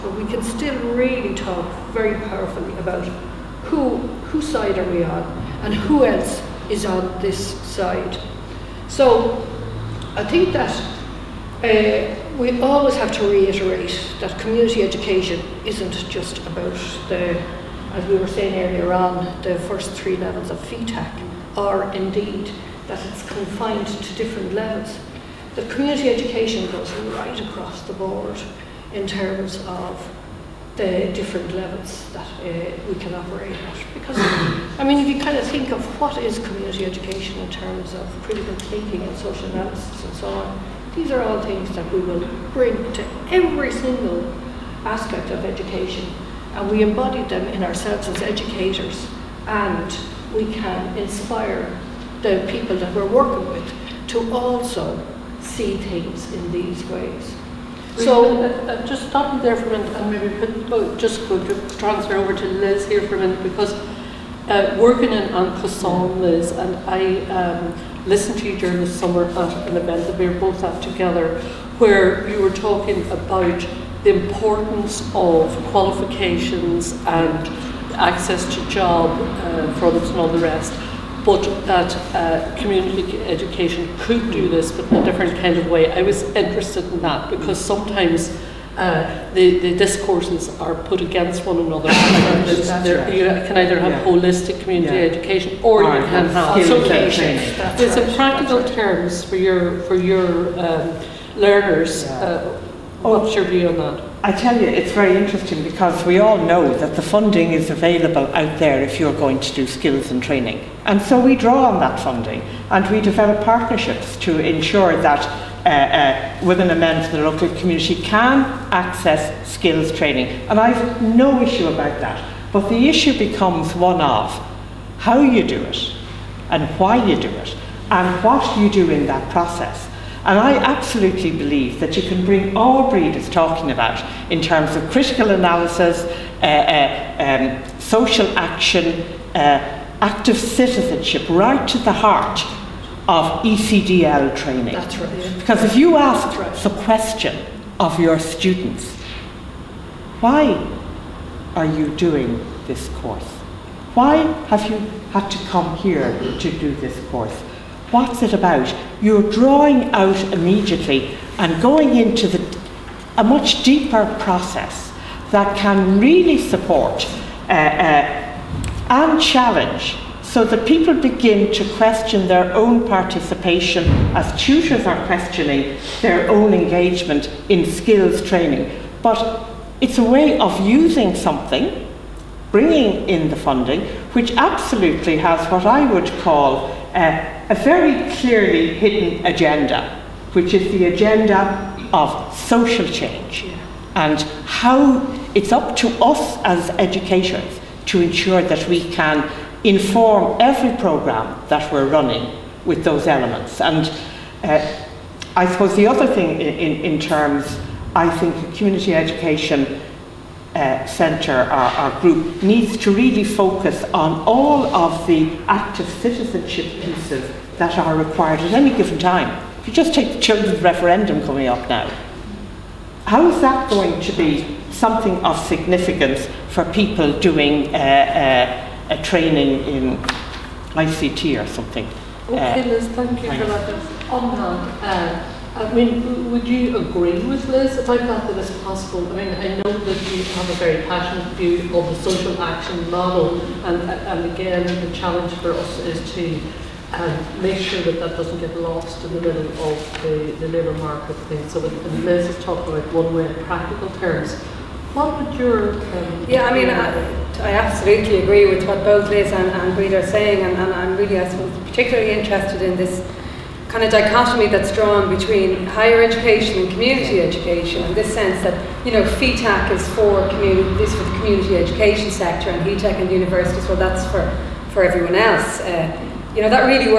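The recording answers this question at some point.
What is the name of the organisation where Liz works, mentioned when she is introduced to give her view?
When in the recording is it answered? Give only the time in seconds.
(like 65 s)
65 s.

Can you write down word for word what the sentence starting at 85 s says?
I was interested in that because sometimes uh, the, the discourses are put against one another.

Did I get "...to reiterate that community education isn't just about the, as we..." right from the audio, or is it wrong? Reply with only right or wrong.
right.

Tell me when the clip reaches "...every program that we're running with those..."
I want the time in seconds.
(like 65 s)
200 s.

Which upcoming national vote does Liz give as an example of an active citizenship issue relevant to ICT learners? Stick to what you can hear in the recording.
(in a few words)
the children's referendum.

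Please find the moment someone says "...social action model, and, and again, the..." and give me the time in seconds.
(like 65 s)
242 s.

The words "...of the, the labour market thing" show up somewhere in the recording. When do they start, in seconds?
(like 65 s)
249 s.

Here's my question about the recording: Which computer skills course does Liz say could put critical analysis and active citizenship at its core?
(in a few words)
ECDL.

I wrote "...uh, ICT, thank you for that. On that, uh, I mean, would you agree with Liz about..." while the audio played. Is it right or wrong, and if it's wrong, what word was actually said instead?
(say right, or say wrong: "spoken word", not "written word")
wrong: "Liz", not "ICT".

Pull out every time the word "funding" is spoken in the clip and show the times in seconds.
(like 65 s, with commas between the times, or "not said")
107 s, 111 s, 183 s.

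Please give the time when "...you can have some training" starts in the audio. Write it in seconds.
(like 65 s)
95 s.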